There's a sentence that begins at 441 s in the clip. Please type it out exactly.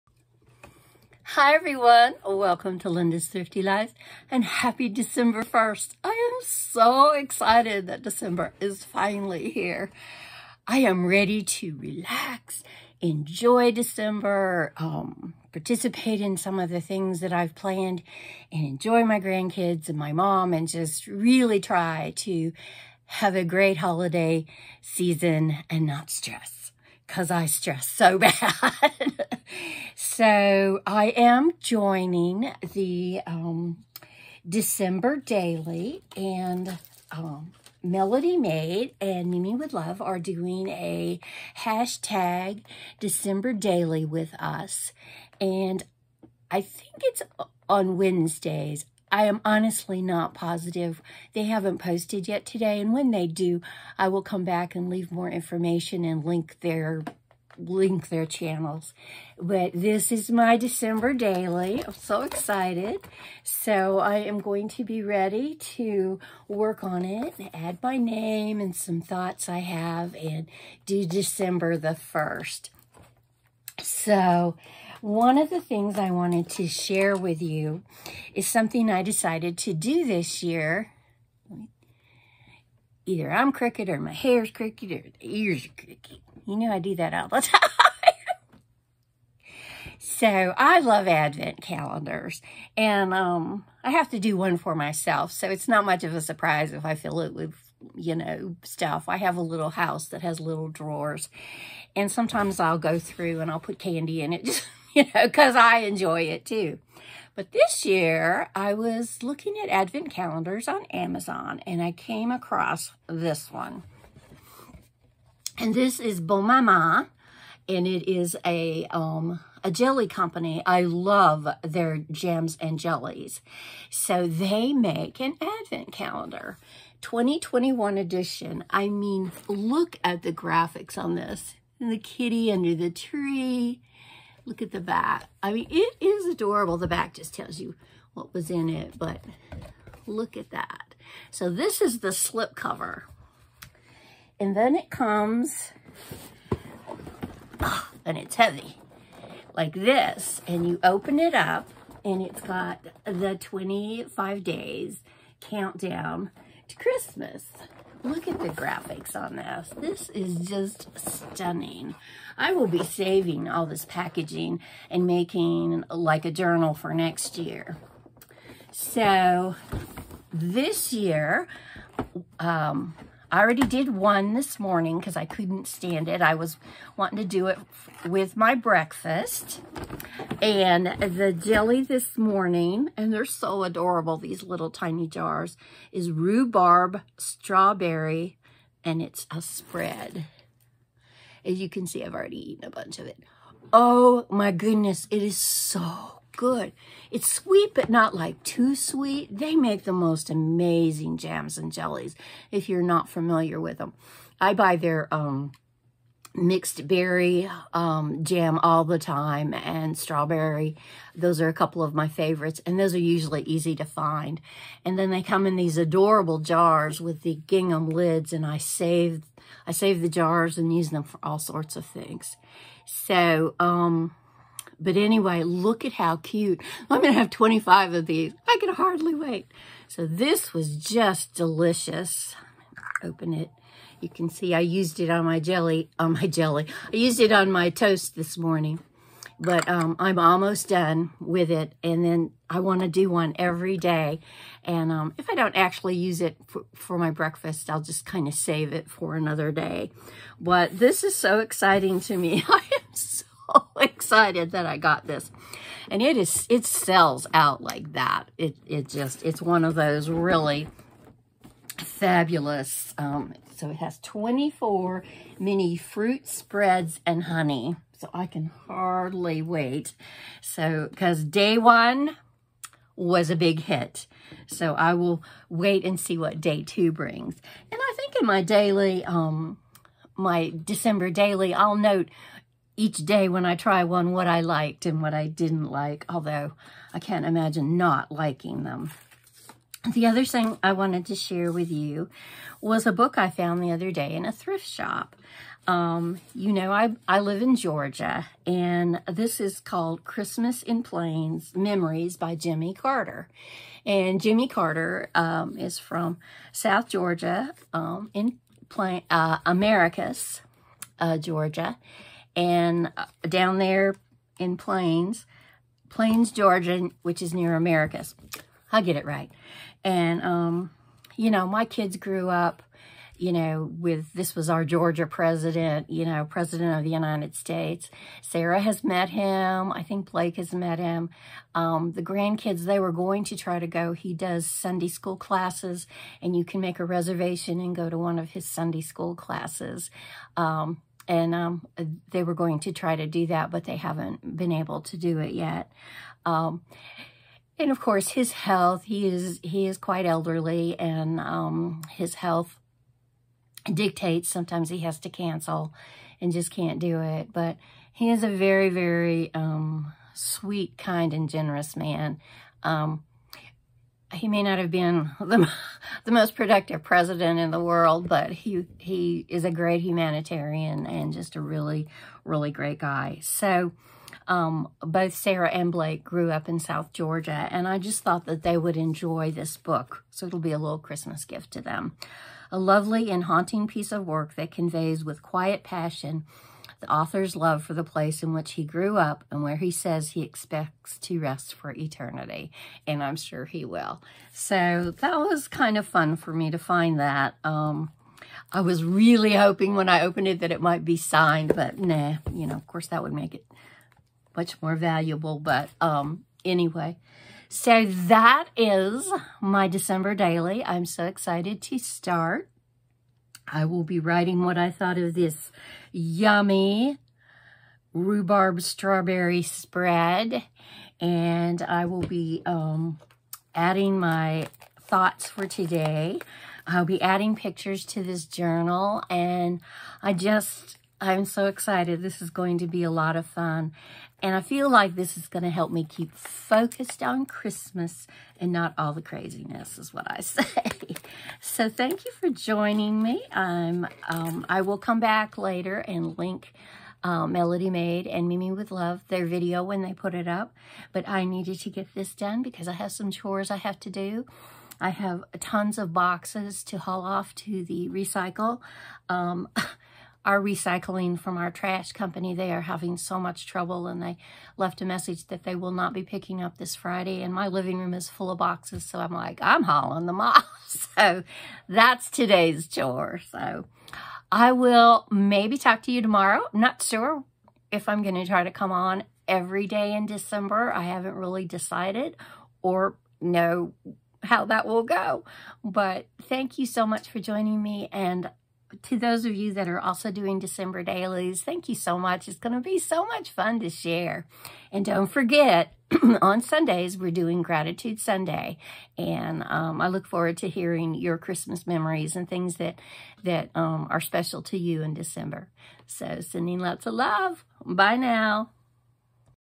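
so thank you for joining me.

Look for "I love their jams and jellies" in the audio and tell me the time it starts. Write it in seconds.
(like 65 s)
120 s.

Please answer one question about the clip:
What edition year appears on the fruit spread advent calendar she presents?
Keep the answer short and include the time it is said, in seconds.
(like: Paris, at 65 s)
2021, at 127 s.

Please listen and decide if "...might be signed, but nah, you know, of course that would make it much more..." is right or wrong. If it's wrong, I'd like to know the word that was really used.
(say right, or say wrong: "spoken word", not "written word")
right.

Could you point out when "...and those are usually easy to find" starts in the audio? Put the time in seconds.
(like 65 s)
212 s.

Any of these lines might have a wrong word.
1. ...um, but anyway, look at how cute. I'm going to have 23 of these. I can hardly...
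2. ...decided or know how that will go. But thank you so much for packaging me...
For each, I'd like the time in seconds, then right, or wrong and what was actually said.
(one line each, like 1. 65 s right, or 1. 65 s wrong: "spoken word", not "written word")
1. 223 s wrong: "25", not "23"
2. 481 s wrong: "joining", not "packaging".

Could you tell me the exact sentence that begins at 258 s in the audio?
It, it just, it's one of those really fabulous, um, so it has 24 mini fruit spreads and honey.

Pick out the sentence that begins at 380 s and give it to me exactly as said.
So it'll be a little Christmas gift to them.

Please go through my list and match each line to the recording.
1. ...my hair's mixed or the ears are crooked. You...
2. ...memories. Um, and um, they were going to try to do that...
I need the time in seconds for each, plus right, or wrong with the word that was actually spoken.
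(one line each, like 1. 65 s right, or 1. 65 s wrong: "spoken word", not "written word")
1. 83 s wrong: "crooked", not "mixed"
2. 339 s wrong: "classes", not "memories".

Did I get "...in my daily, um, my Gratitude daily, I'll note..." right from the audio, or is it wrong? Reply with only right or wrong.
wrong.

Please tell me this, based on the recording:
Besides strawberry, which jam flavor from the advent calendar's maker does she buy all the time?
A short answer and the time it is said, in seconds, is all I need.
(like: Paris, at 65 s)
Mixed berry, at 206 s.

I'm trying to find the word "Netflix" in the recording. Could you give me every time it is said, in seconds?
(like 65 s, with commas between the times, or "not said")
not said.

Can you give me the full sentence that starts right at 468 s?
So I'm like, I'm hauling them off.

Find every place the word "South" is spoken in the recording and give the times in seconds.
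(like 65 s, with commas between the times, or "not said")
306 s, 376 s.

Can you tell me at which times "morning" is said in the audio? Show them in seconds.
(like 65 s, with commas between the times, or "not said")
174 s, 182 s, 238 s.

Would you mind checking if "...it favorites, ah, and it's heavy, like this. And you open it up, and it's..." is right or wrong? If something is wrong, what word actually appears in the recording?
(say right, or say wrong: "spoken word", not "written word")
wrong: "comes", not "favorites".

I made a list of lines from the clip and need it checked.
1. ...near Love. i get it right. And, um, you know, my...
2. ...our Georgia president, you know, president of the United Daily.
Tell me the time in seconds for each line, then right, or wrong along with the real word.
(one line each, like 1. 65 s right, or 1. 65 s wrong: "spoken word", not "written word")
1. 317 s wrong: "Americus", not "Love"
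2. 324 s wrong: "States", not "Daily".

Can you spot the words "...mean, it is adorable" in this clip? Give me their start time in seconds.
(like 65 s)
135 s.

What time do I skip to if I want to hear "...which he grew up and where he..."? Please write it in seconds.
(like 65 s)
388 s.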